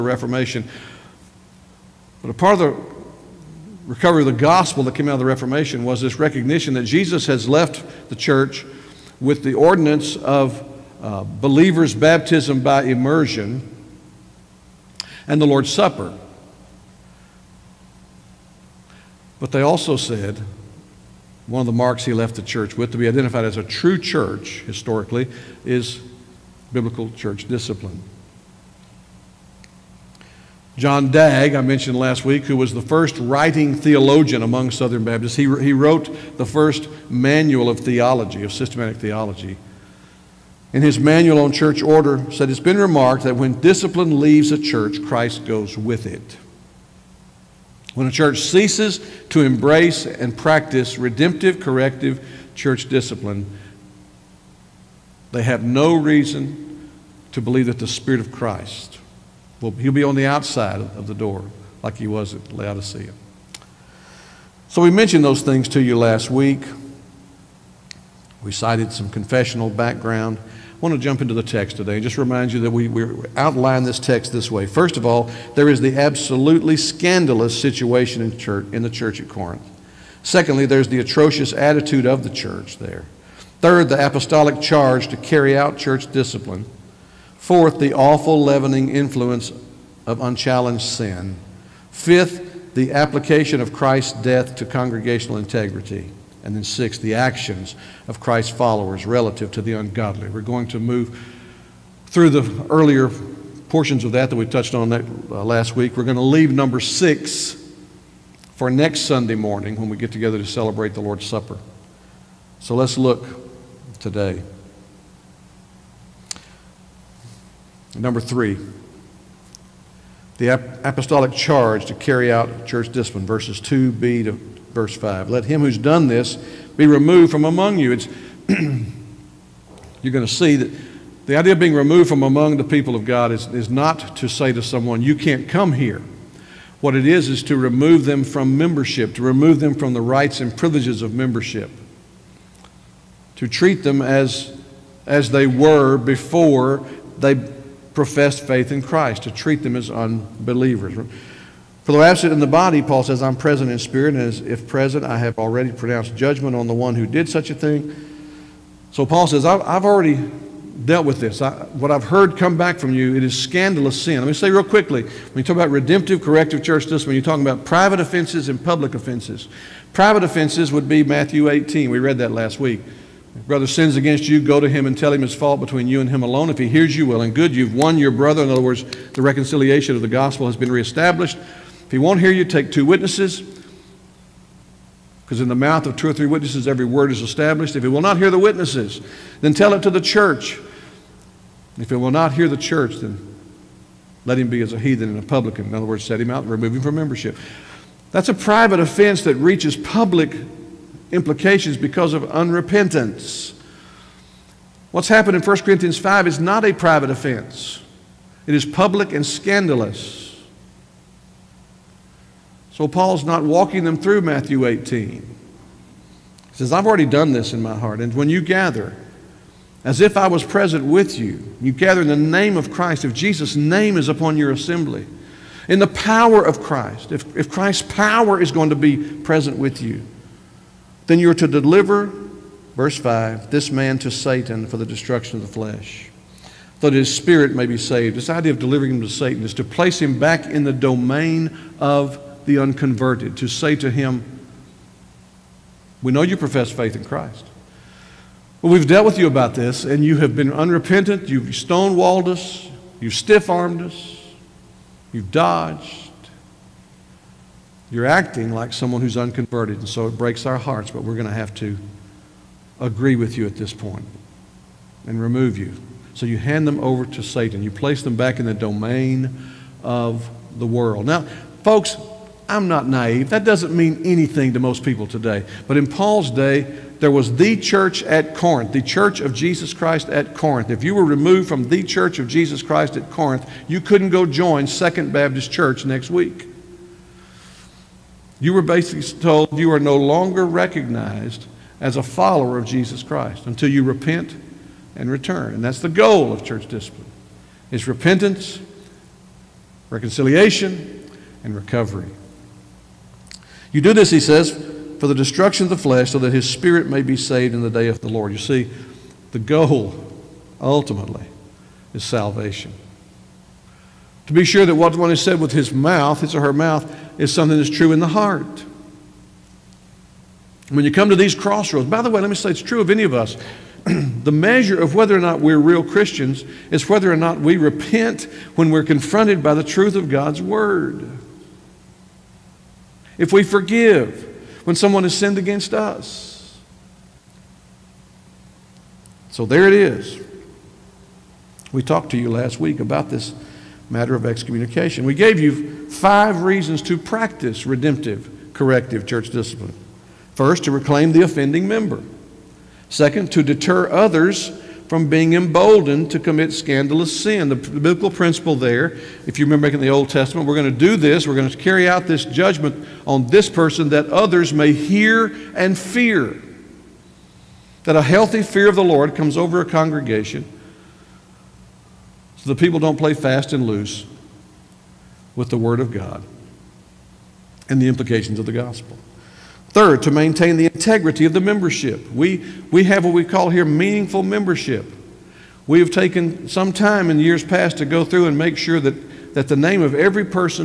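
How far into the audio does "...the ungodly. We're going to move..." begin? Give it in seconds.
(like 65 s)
99 s.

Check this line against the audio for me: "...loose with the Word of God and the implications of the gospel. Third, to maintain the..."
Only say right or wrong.
right.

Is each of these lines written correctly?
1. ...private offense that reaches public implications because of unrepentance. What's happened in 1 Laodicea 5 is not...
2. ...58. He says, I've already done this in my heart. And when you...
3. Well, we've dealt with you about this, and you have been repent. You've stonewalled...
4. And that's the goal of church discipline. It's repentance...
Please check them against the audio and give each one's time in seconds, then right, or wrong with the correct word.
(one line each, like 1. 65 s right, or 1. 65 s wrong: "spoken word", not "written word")
1. 198 s wrong: "Corinthians", not "Laodicea"
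2. 214 s wrong: "18", not "58"
3. 248 s wrong: "unrepentant", not "repent"
4. 295 s right.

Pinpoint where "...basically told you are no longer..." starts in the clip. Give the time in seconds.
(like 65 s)
288 s.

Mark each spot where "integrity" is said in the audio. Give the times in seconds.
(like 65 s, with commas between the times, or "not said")
95 s, 380 s.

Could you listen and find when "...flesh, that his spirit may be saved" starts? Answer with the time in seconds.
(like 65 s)
235 s.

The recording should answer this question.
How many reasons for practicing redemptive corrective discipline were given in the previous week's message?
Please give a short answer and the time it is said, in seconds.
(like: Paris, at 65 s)
5, at 345 s.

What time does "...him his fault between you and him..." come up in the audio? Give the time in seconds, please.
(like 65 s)
175 s.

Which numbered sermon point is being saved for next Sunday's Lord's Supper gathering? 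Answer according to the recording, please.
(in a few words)
6.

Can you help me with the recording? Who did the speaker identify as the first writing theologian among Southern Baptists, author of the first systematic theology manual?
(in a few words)
John Dagg.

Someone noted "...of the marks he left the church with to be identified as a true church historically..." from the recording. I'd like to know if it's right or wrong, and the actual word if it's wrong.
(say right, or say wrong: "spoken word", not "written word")
right.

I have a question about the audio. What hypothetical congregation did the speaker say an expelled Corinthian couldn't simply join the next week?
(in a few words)
Second Baptist Church.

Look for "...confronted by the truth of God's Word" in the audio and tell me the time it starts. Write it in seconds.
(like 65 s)
328 s.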